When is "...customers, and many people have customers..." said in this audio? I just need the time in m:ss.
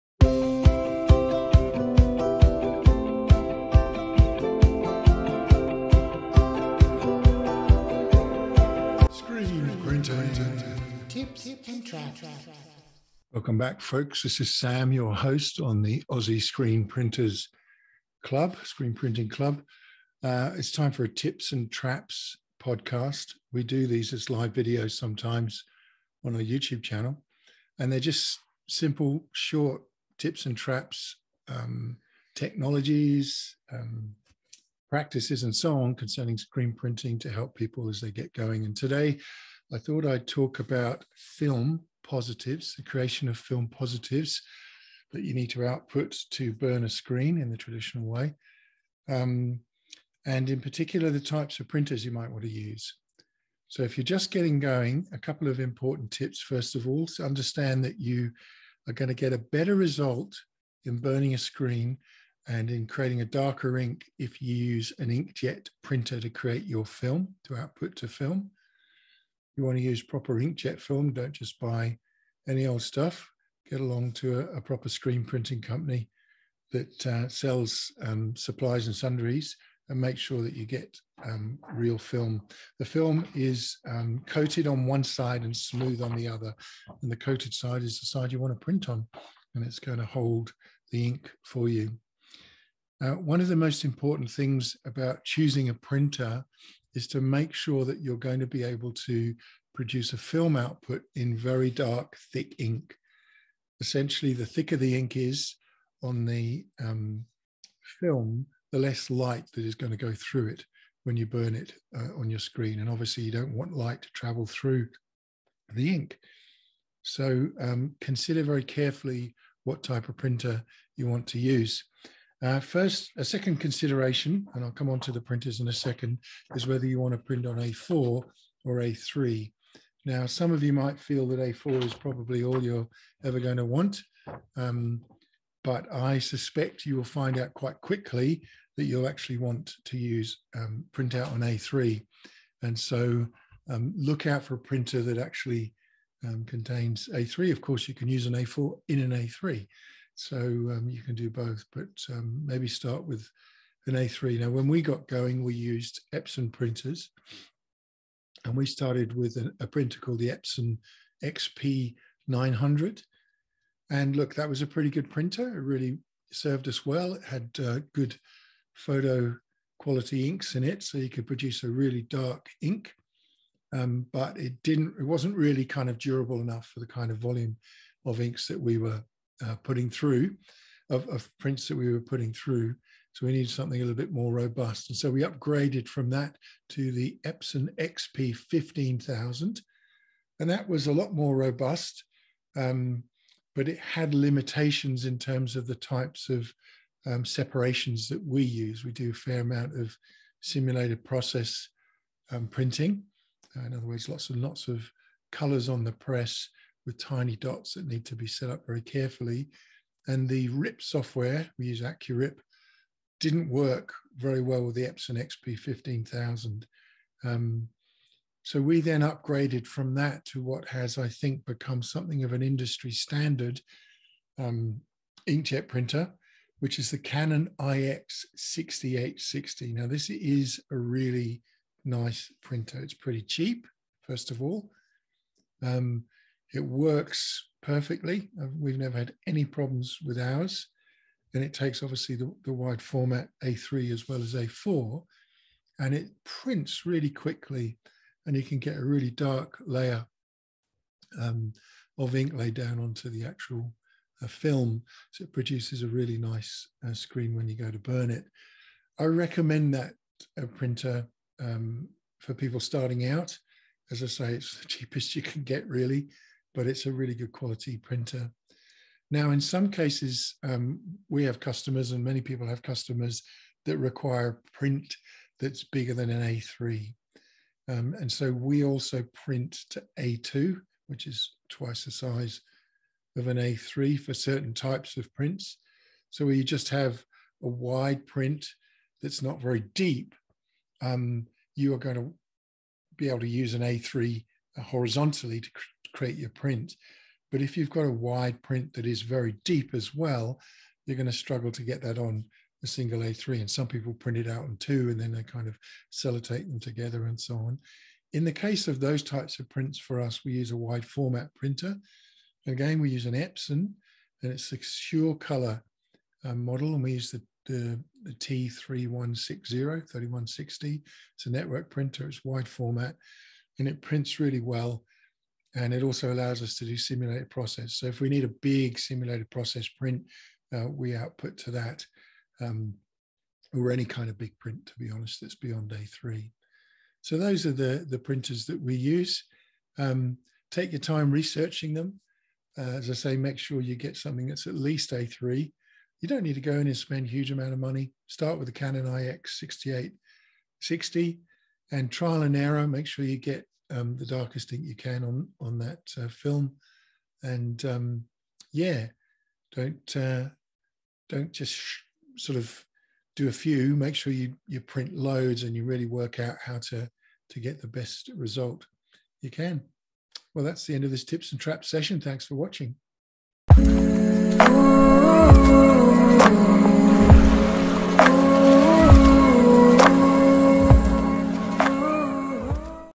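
4:31.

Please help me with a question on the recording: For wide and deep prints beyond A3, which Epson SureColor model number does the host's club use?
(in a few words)
T3160.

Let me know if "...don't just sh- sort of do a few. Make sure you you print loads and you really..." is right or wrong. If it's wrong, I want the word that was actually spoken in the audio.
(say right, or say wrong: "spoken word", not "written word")
right.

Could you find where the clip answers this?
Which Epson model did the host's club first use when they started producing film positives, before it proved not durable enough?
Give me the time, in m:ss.
2:40.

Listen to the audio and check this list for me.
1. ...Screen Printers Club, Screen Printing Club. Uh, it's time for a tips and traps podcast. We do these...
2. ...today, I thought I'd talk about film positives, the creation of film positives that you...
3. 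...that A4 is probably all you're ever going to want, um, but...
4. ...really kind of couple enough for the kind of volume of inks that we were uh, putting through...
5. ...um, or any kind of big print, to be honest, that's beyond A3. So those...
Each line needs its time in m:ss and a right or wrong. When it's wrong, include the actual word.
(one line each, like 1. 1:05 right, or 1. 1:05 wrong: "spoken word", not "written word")
1. 0:16 right
2. 0:38 right
3. 2:11 right
4. 2:55 wrong: "durable", not "couple"
5. 5:32 right.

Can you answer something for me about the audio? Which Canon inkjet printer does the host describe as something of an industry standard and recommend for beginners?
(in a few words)
Canon IX6860.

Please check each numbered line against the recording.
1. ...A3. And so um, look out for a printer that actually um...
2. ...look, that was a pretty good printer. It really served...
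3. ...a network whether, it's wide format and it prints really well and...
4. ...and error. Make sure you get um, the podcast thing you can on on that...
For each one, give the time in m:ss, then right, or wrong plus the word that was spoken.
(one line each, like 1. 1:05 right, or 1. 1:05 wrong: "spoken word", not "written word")
1. 2:21 right
2. 2:44 right
3. 5:21 wrong: "printer", not "whether"
4. 5:52 wrong: "darkest", not "podcast".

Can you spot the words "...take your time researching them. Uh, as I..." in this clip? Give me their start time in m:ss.
5:40.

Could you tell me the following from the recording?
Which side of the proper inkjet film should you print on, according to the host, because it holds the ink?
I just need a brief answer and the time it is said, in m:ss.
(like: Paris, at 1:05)
The coated side, at 1:27.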